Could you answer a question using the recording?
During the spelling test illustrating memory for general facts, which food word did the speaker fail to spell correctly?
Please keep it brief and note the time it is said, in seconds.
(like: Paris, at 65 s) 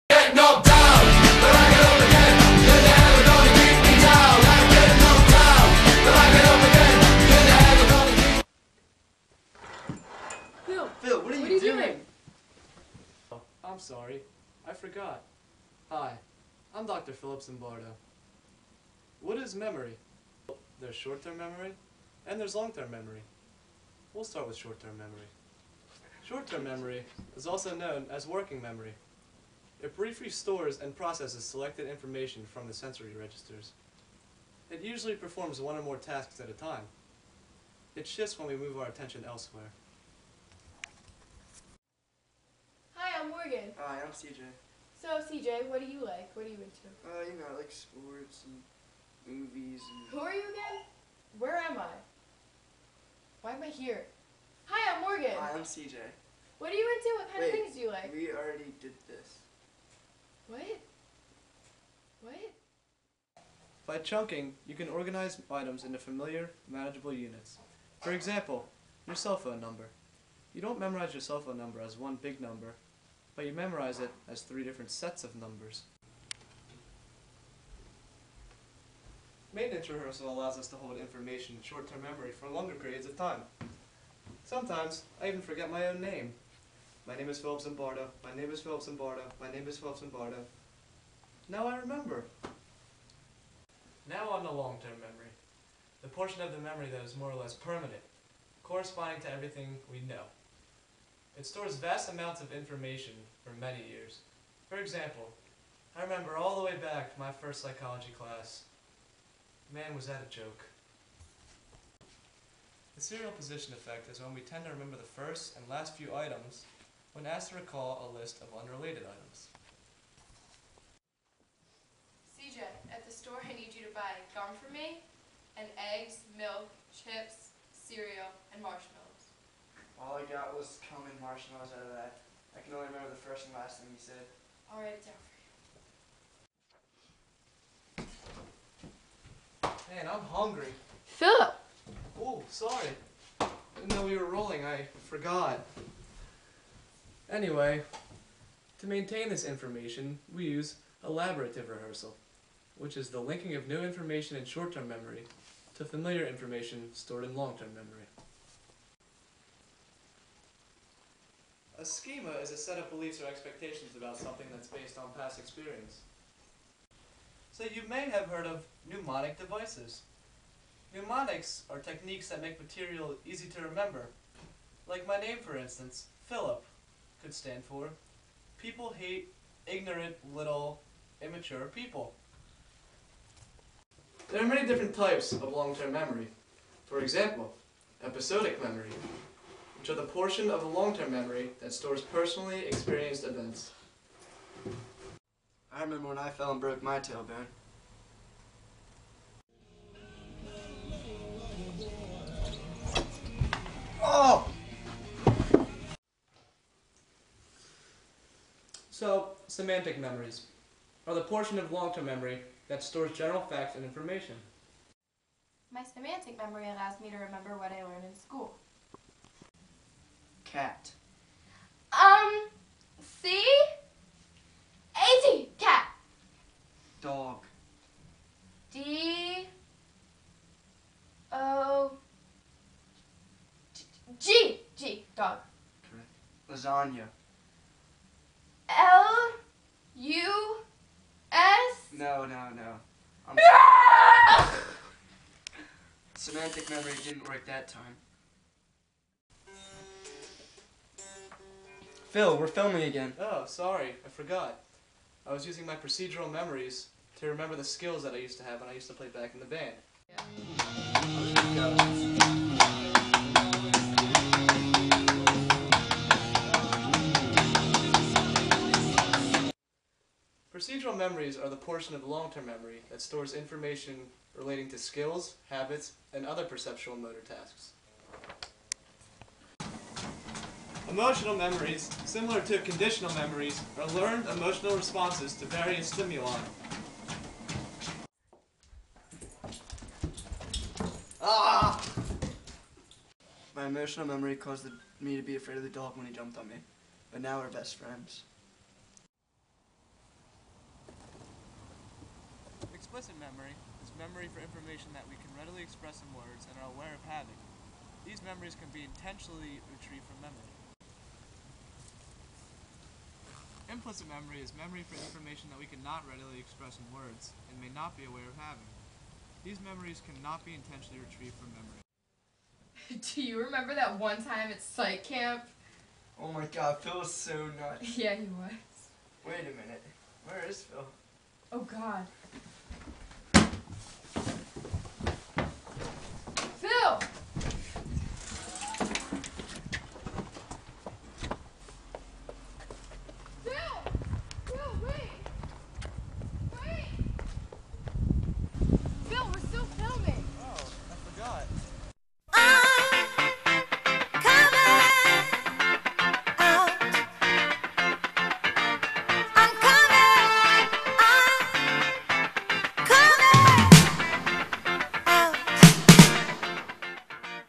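Lasagna, at 236 s.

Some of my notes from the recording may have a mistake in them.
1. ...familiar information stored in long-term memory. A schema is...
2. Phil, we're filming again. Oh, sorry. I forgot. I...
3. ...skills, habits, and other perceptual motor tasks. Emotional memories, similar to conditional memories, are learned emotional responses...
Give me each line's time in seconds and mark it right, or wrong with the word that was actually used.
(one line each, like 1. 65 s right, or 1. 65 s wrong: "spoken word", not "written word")
1. 155 s right
2. 252 s right
3. 274 s right.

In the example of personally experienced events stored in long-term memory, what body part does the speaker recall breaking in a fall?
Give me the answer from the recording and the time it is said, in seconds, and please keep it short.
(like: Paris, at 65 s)
tailbone, at 196 s.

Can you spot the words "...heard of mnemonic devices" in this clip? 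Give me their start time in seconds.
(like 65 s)
168 s.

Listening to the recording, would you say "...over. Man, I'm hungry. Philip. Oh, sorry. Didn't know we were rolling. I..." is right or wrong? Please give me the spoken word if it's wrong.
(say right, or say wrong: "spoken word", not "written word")
right.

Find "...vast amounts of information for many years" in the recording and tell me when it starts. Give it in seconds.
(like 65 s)
101 s.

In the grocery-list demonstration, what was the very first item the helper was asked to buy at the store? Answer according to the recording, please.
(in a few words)
gum.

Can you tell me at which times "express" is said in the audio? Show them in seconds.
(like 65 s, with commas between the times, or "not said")
305 s, 316 s.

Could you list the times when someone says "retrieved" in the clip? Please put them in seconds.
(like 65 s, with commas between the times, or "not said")
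309 s, 320 s.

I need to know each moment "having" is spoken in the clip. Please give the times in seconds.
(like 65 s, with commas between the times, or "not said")
307 s, 318 s.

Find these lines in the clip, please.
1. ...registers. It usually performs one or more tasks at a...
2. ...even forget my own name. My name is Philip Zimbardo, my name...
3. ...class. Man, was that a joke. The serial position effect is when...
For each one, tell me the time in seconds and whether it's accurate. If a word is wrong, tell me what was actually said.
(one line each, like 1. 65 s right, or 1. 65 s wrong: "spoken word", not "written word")
1. 33 s right
2. 85 s right
3. 108 s right.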